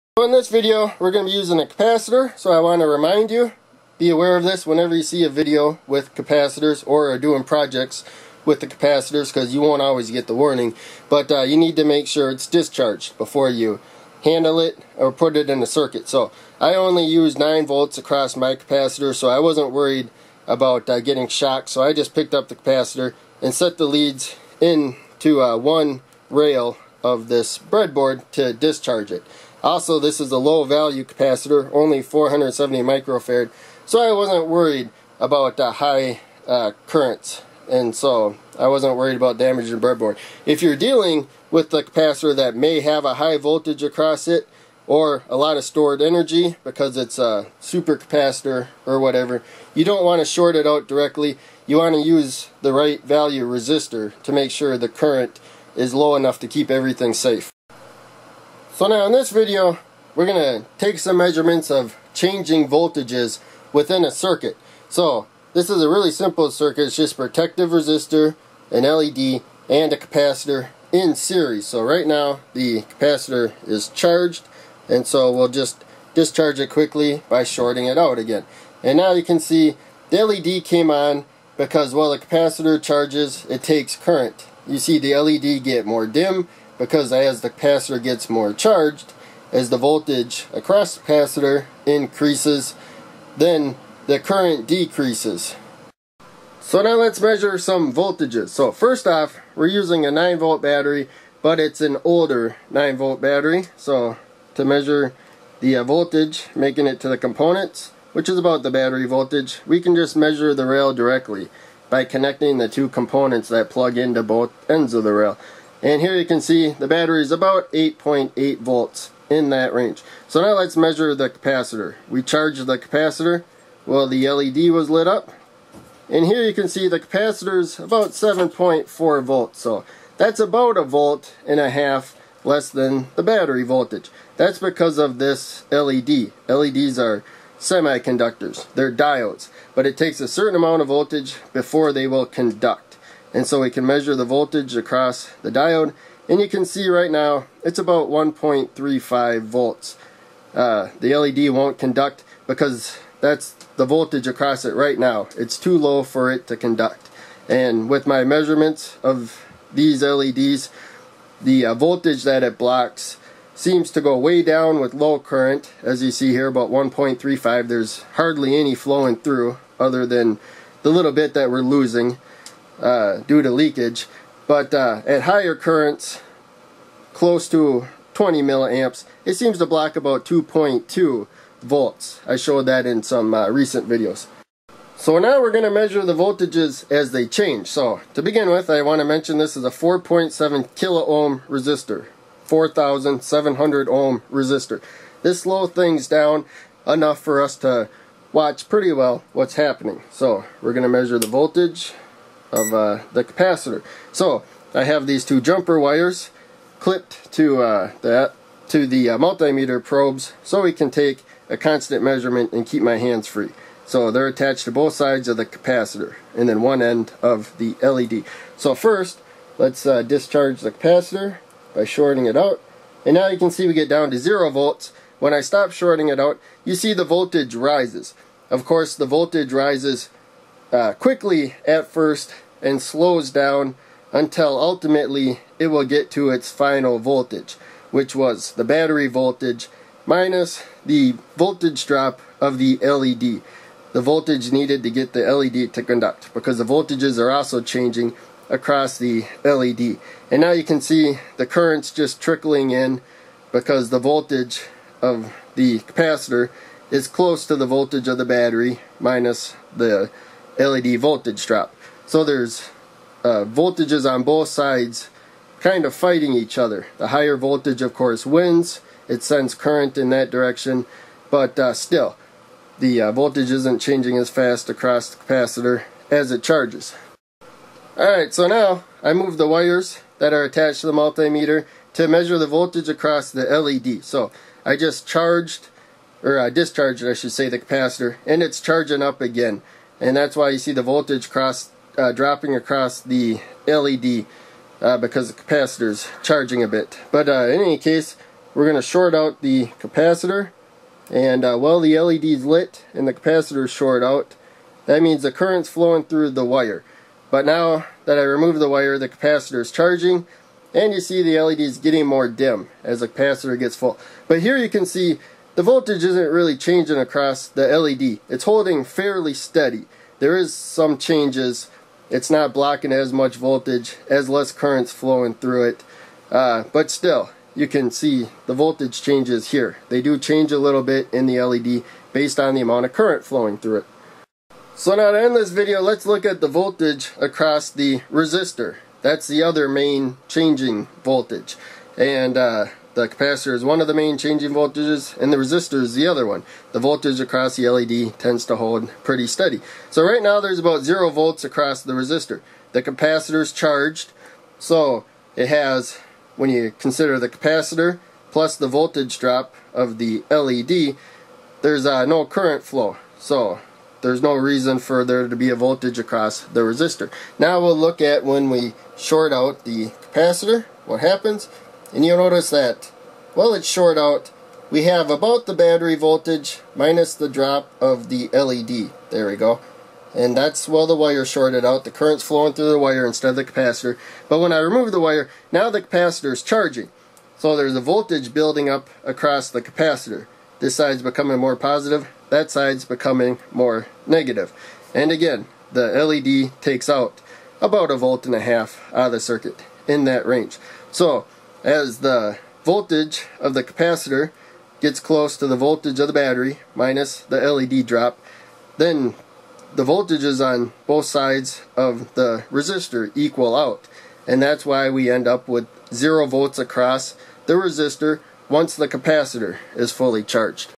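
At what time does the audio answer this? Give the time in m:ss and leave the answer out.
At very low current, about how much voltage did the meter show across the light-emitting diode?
2:28.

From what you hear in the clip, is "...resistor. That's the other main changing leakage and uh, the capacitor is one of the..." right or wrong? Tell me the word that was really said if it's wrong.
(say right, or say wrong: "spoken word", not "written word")
wrong: "voltage", not "leakage".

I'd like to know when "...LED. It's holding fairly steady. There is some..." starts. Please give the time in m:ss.
5:17.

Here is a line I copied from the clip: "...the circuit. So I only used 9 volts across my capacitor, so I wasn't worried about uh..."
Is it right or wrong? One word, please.
right.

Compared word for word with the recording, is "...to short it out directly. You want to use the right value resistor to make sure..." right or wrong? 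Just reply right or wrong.
right.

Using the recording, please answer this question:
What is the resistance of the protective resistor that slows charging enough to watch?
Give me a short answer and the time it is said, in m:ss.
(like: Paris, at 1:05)
4.7 kilo ohm, at 3:09.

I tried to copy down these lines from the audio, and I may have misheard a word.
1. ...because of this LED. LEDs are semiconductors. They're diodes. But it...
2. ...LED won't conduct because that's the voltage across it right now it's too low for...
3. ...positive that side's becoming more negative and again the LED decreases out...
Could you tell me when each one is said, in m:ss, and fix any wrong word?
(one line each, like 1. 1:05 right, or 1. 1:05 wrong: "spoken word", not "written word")
1. 2:14 right
2. 2:31 right
3. 6:31 wrong: "takes", not "decreases".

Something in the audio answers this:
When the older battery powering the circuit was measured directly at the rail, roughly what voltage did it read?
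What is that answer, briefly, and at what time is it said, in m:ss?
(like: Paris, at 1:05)
8.8 volts, at 1:57.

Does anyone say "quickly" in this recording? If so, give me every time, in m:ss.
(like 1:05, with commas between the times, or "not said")
1:16, 3:50.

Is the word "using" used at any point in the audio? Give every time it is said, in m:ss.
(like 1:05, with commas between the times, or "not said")
0:01, 1:39.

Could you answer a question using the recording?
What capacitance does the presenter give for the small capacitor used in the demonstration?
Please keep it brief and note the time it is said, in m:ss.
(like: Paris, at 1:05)
470 microfarad, at 0:32.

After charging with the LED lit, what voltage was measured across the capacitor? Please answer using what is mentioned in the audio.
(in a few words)
7.4 volts.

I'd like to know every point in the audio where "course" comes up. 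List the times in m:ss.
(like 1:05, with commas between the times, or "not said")
3:48, 4:27.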